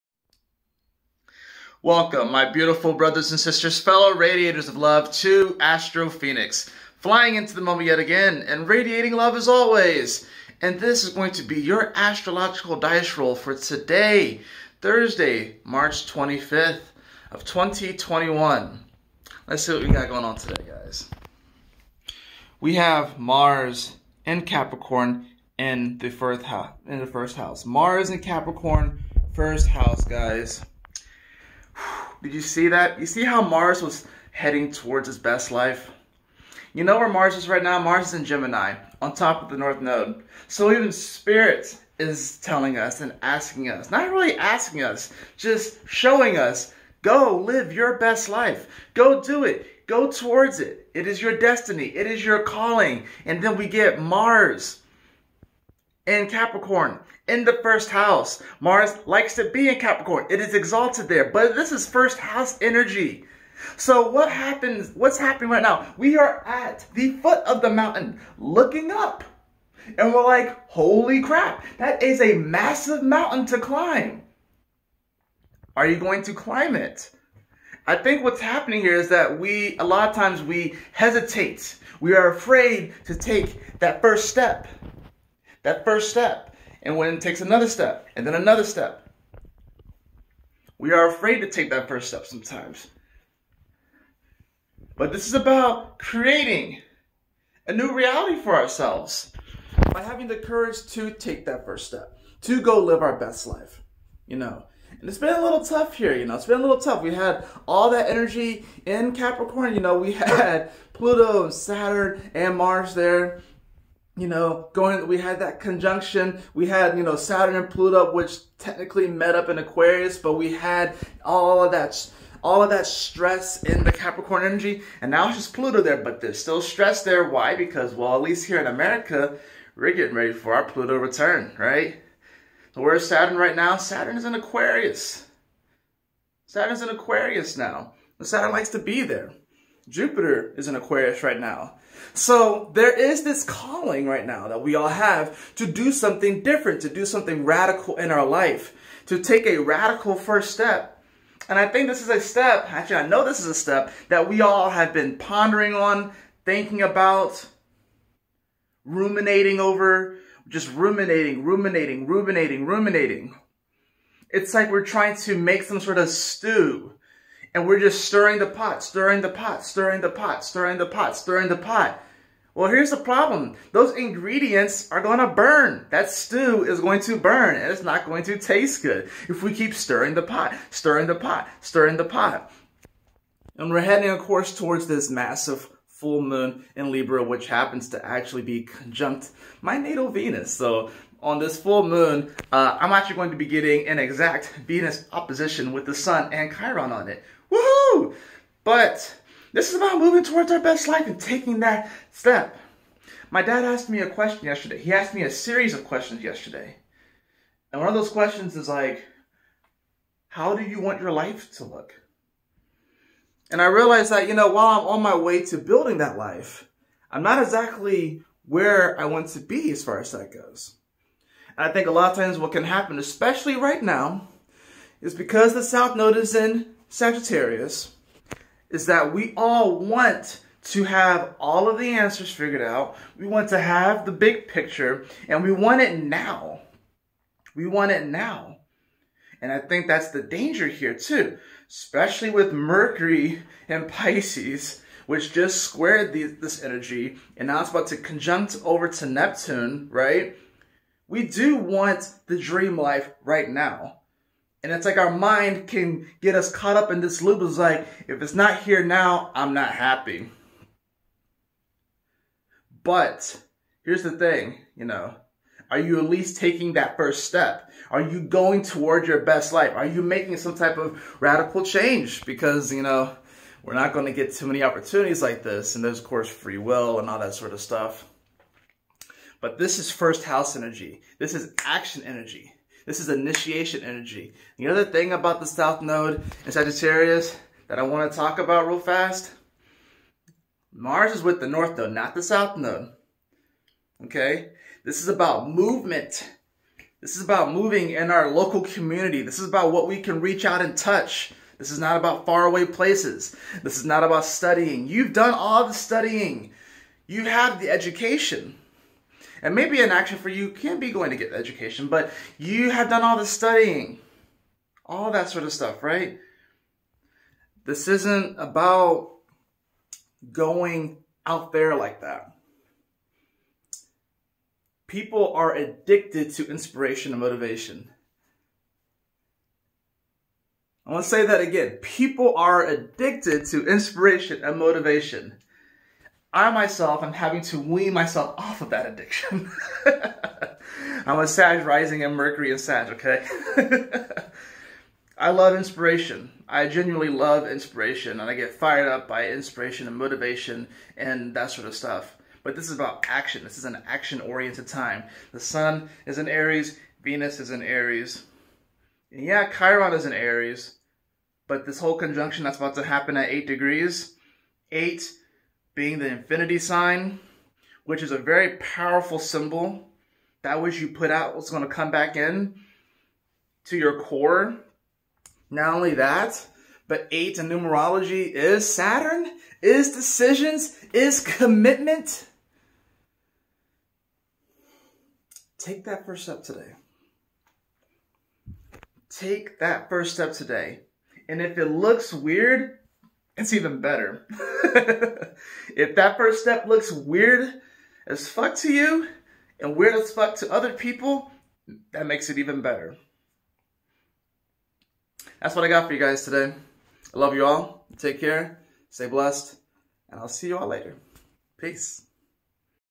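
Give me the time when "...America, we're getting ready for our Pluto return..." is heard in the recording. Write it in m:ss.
2:08.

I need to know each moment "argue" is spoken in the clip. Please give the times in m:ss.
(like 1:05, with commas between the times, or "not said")
not said.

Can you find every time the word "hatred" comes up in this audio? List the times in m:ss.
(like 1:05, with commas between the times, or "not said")
not said.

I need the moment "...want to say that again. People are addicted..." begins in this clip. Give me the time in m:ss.
5:30.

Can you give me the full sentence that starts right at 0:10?
And this is going to be your astrological dice roll for today, Thursday, March 25th of 2021.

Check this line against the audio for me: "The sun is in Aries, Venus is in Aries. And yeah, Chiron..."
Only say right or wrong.
right.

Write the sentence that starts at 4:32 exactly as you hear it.
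Because, you know, we're not going to get too many opportunities like this.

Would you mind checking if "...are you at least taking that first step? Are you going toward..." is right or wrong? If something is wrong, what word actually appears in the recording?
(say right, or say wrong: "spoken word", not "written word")
right.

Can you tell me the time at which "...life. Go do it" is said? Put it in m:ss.
0:48.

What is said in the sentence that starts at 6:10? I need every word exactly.
That which you put out is going to come back in to your core.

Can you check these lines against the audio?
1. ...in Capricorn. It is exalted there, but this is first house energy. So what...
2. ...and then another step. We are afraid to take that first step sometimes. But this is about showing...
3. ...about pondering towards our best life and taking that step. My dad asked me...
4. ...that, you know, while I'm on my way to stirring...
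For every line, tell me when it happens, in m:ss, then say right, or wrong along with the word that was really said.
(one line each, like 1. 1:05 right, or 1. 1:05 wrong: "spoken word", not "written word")
1. 0:59 right
2. 1:28 wrong: "creating", not "showing"
3. 3:19 wrong: "moving", not "pondering"
4. 3:34 wrong: "building", not "stirring".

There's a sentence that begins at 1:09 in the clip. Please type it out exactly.
And we're like, holy crap, that is a massive mountain to climb.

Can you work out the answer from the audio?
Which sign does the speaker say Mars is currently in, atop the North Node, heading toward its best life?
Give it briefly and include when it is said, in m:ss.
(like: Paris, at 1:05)
Gemini, at 0:38.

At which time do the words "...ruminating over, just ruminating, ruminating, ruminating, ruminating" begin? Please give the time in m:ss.
2:38.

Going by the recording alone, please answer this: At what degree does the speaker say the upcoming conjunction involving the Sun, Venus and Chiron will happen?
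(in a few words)
8 degrees.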